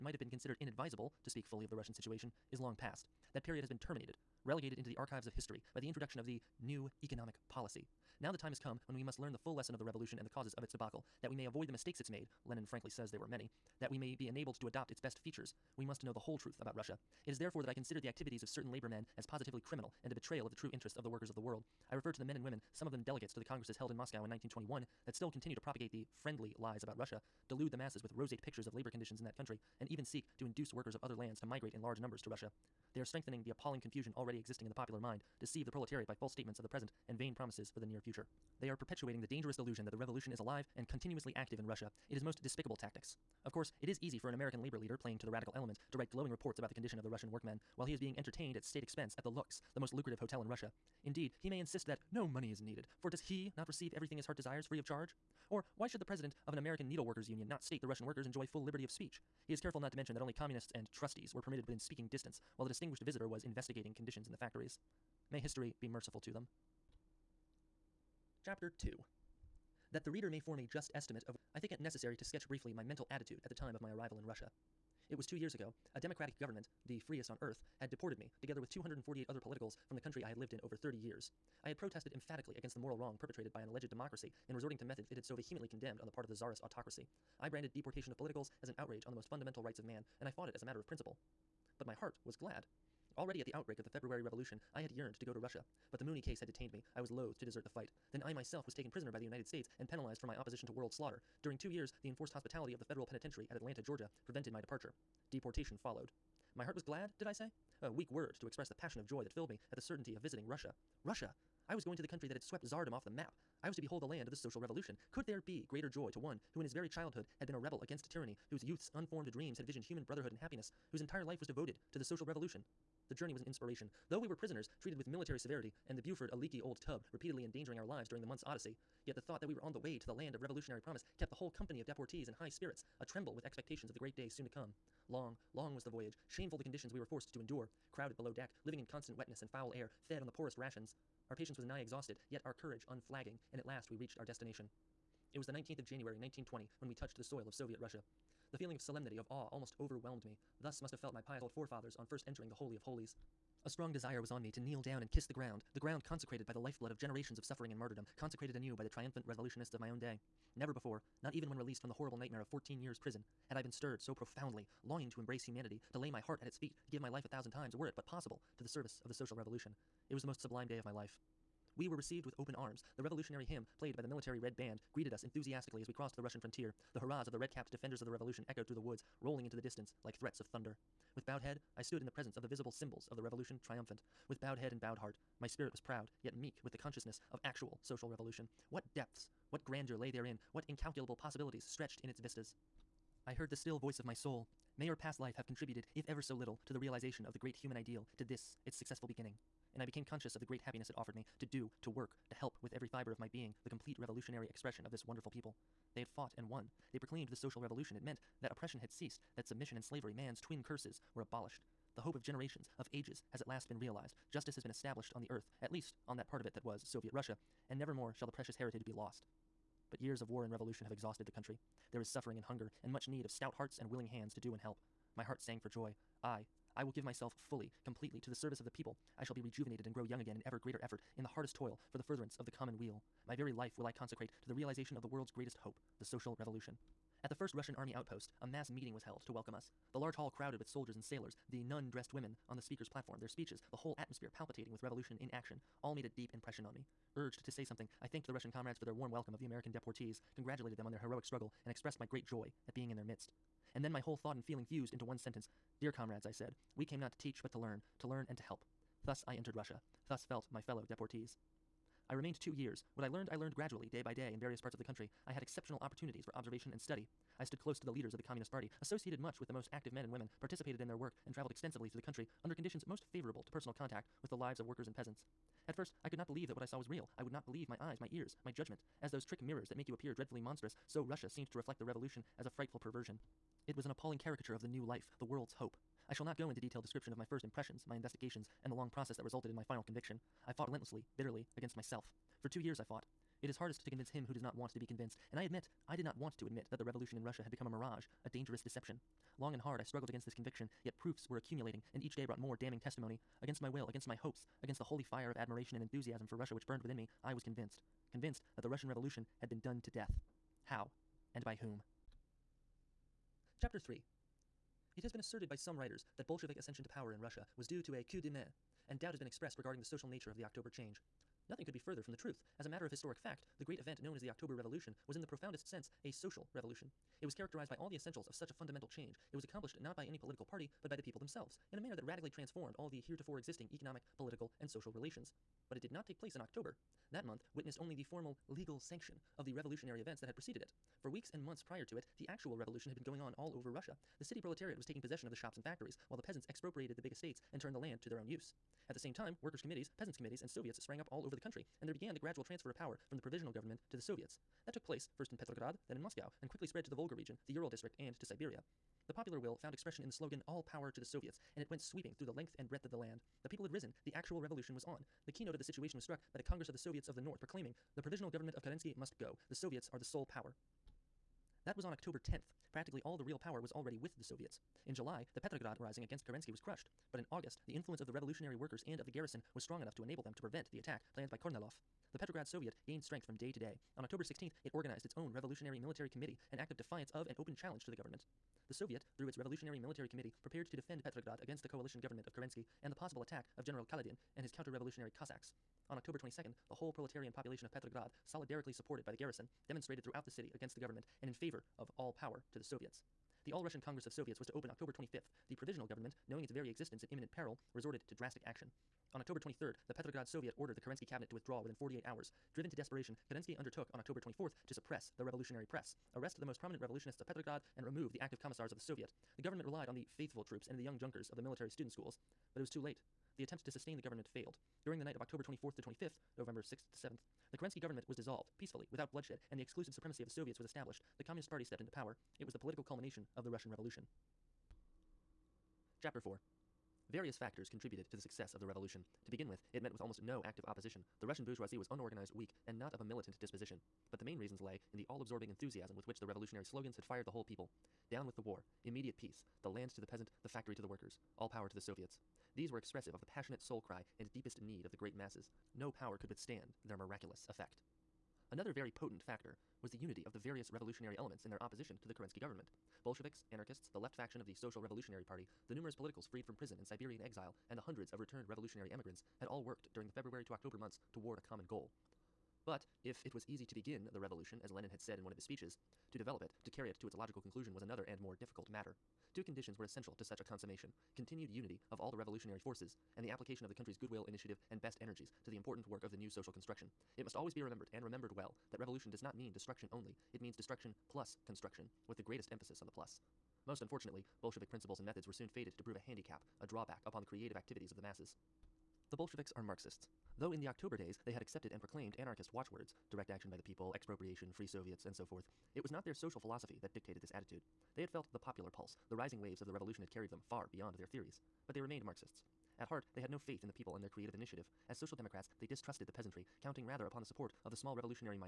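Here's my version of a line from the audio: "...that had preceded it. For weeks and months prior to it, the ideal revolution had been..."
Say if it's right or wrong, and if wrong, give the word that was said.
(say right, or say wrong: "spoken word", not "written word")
wrong: "actual", not "ideal".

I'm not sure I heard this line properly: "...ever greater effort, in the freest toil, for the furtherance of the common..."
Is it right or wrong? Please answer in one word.
wrong.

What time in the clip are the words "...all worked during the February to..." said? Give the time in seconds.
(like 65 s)
469 s.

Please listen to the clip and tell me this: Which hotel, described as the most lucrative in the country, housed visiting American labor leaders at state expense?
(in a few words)
the Lux.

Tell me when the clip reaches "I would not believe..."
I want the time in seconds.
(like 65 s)
277 s.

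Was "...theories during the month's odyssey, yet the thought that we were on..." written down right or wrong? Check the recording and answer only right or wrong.
wrong.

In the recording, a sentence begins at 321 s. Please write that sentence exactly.
Nothing could be further from the truth.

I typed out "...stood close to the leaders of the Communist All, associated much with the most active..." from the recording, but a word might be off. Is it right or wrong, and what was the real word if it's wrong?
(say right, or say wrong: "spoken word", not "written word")
wrong: "Party", not "All".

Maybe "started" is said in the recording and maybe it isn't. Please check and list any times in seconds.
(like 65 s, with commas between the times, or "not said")
not said.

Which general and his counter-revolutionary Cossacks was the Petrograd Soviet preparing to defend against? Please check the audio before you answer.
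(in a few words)
General Kaledin.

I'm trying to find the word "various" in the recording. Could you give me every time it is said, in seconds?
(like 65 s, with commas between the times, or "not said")
264 s, 437 s, 460 s.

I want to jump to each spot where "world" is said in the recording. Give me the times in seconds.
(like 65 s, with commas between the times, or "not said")
21 s, 100 s, 235 s, 285 s.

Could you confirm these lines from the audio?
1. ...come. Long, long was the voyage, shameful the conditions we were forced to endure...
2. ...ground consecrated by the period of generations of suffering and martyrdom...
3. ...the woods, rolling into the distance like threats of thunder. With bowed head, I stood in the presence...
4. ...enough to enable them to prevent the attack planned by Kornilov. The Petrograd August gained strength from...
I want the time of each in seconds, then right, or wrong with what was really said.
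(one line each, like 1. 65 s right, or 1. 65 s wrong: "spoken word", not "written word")
1. 134 s right
2. 155 s wrong: "lifeblood", not "period"
3. 178 s right
4. 379 s wrong: "Soviet", not "August".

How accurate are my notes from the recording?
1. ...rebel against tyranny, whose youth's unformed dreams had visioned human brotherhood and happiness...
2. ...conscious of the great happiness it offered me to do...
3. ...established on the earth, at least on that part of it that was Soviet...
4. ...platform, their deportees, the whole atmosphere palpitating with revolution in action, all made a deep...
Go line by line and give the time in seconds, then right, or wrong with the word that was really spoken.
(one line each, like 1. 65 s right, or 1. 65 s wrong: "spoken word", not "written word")
1. 117 s right
2. 200 s right
3. 214 s right
4. 242 s wrong: "speeches", not "deportees".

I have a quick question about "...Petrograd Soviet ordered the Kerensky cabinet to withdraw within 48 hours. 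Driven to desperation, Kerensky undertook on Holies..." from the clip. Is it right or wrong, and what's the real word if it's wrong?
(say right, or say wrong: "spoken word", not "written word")
wrong: "October", not "Holies".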